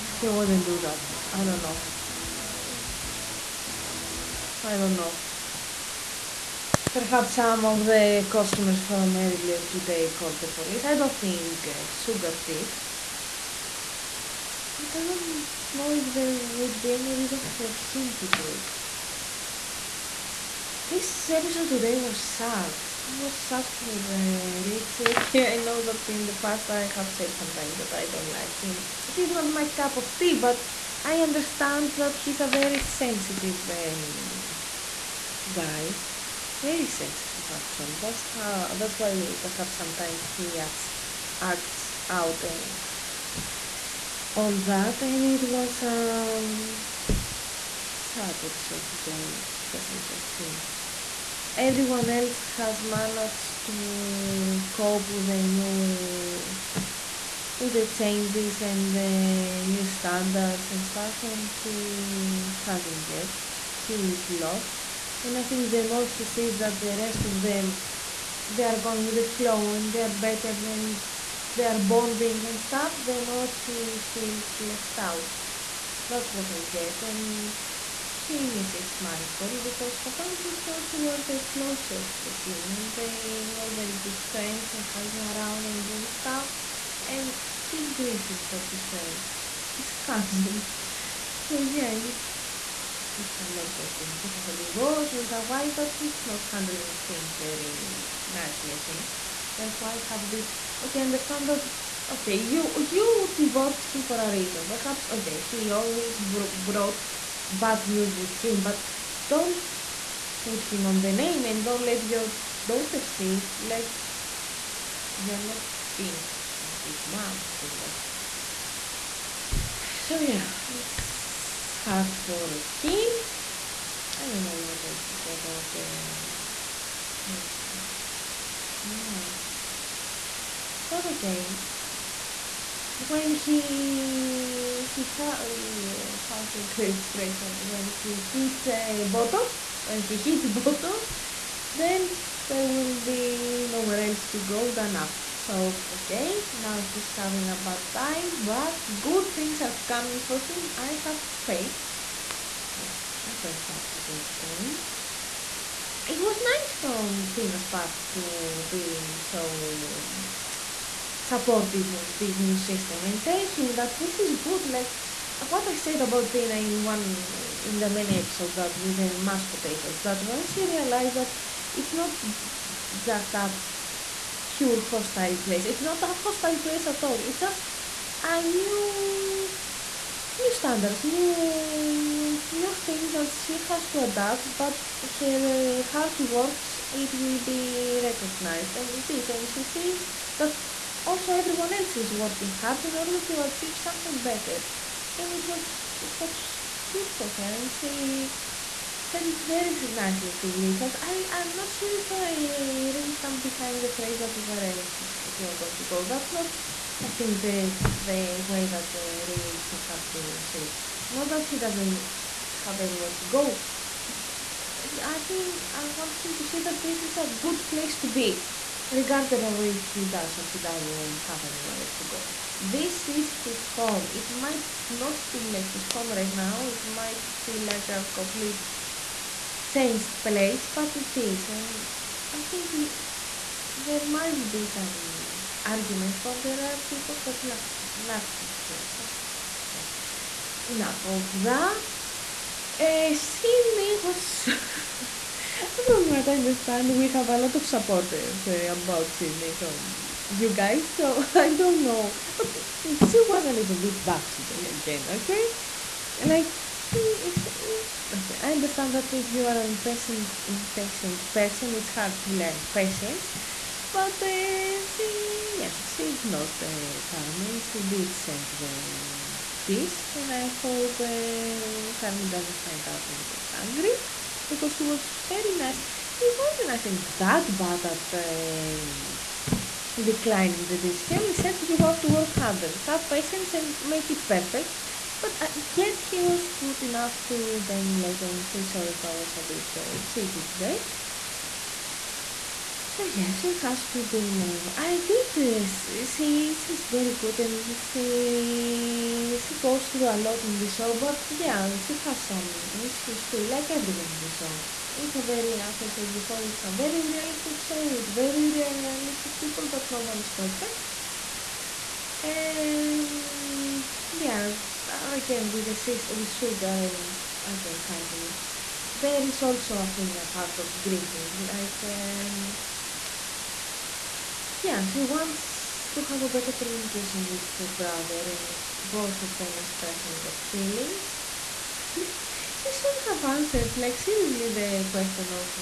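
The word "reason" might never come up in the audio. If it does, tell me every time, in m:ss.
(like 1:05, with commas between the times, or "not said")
0:17, 1:44.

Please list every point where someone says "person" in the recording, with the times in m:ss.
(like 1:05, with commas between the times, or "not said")
4:21.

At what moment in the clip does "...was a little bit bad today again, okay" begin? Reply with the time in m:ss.
4:13.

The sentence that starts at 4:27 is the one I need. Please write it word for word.
She did serve the dish, and I hope uh, Carmen doesn't find out and gets angry because he was very nice.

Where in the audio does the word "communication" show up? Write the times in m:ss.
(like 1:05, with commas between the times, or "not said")
5:26.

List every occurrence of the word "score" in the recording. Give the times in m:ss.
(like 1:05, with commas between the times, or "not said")
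not said.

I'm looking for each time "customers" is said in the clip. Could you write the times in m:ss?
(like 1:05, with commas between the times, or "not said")
0:08.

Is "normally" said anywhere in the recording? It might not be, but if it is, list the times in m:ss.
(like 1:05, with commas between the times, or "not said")
not said.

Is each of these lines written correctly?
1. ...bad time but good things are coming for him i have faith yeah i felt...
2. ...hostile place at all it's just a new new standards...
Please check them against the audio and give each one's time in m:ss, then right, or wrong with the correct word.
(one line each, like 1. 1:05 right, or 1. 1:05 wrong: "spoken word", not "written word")
1. 2:27 right
2. 2:56 right.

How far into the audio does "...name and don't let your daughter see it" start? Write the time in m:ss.
1:51.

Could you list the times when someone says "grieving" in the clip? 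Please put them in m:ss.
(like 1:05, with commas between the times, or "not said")
1:27, 5:20.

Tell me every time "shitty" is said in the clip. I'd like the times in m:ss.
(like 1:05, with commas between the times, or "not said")
4:50.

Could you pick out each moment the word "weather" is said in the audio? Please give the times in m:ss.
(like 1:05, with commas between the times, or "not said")
not said.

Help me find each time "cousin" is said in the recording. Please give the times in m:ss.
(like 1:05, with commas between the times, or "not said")
1:30.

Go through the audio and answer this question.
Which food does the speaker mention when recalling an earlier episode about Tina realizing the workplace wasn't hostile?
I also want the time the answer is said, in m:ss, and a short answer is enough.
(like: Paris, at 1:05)
mashed potatoes, at 2:49.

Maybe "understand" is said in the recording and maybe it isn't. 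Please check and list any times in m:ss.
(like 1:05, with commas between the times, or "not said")
0:31, 1:41, 4:06, 4:18.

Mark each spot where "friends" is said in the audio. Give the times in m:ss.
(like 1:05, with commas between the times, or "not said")
1:24, 1:28.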